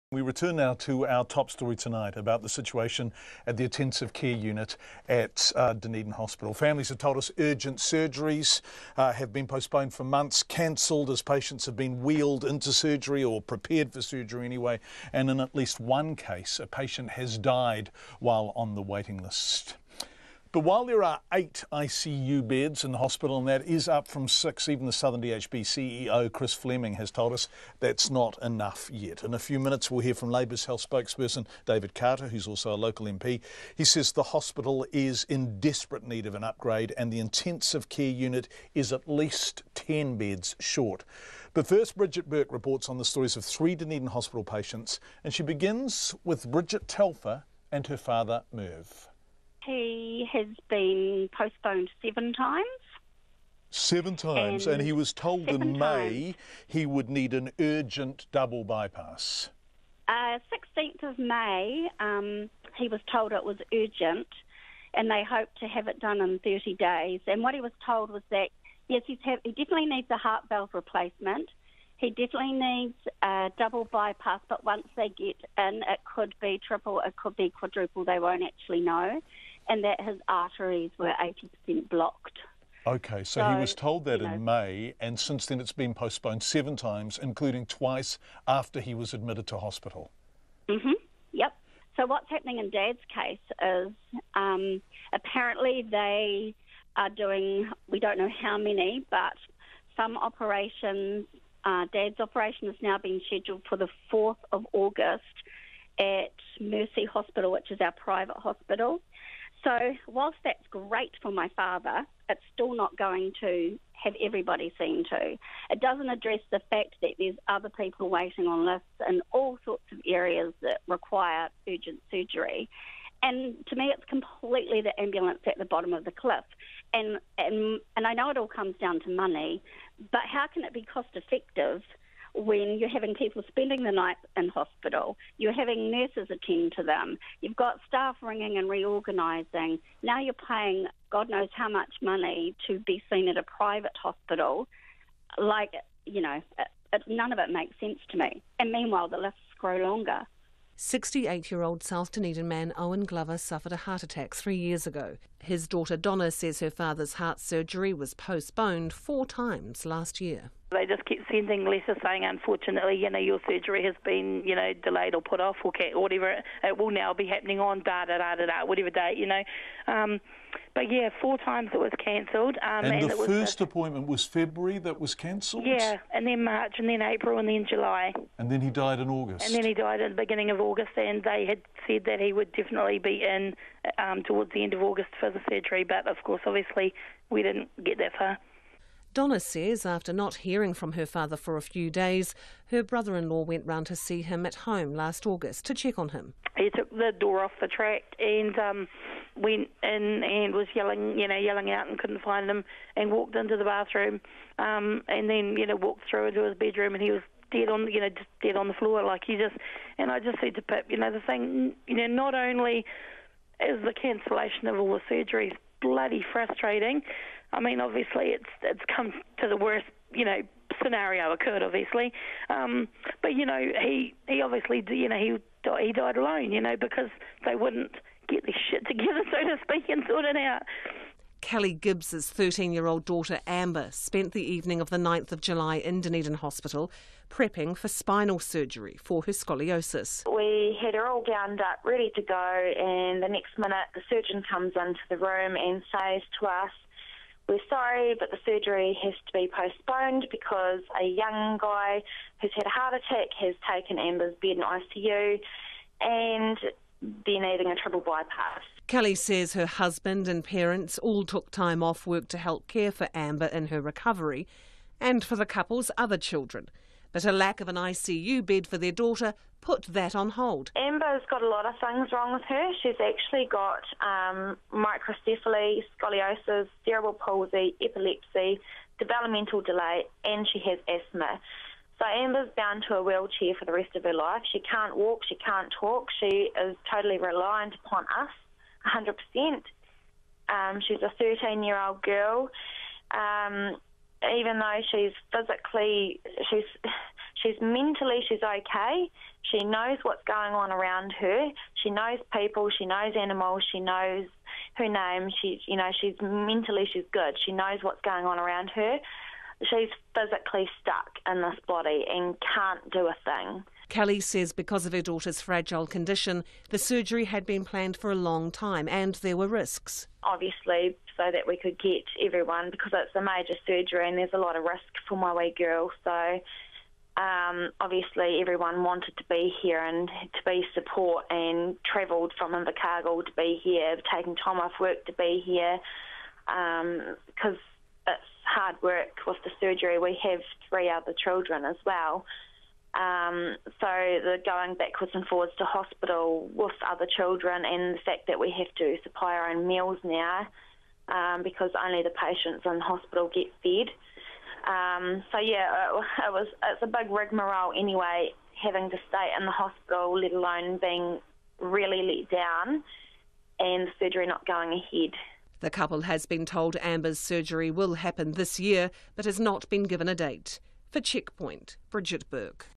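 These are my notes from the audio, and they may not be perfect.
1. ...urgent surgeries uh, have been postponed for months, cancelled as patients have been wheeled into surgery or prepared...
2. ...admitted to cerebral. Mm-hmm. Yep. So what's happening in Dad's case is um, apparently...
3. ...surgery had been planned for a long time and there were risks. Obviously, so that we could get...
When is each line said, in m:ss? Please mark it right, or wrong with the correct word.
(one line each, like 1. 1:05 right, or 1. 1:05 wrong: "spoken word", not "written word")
1. 0:07 right
2. 1:29 wrong: "hospital", not "cerebral"
3. 5:16 right.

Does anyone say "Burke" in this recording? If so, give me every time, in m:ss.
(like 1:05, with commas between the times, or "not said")
0:42, 6:12.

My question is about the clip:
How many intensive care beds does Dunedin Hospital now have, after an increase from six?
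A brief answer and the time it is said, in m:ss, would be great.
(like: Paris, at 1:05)
8, at 0:21.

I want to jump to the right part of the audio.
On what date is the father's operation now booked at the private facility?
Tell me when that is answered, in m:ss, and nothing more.
1:44.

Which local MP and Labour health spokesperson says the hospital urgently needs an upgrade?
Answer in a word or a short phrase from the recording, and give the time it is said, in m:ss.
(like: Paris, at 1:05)
David Carter, at 0:31.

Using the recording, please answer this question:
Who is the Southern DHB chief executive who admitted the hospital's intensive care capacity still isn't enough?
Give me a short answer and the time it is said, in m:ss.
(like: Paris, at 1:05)
Chris Fleming, at 0:26.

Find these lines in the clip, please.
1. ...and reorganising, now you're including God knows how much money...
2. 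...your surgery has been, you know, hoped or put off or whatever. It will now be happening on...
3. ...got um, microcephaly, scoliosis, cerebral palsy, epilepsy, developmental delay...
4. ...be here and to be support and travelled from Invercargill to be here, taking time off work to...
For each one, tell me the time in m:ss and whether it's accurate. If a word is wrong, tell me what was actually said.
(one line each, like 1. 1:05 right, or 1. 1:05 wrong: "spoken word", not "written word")
1. 2:18 wrong: "paying", not "including"
2. 2:43 wrong: "delayed", not "hoped"
3. 4:33 right
4. 5:29 right.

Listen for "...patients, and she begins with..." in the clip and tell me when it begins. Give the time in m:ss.
0:44.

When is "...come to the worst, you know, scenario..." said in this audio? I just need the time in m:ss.
3:38.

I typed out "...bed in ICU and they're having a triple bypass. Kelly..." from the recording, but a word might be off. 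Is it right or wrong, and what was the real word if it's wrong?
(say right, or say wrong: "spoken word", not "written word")
wrong: "needing", not "having".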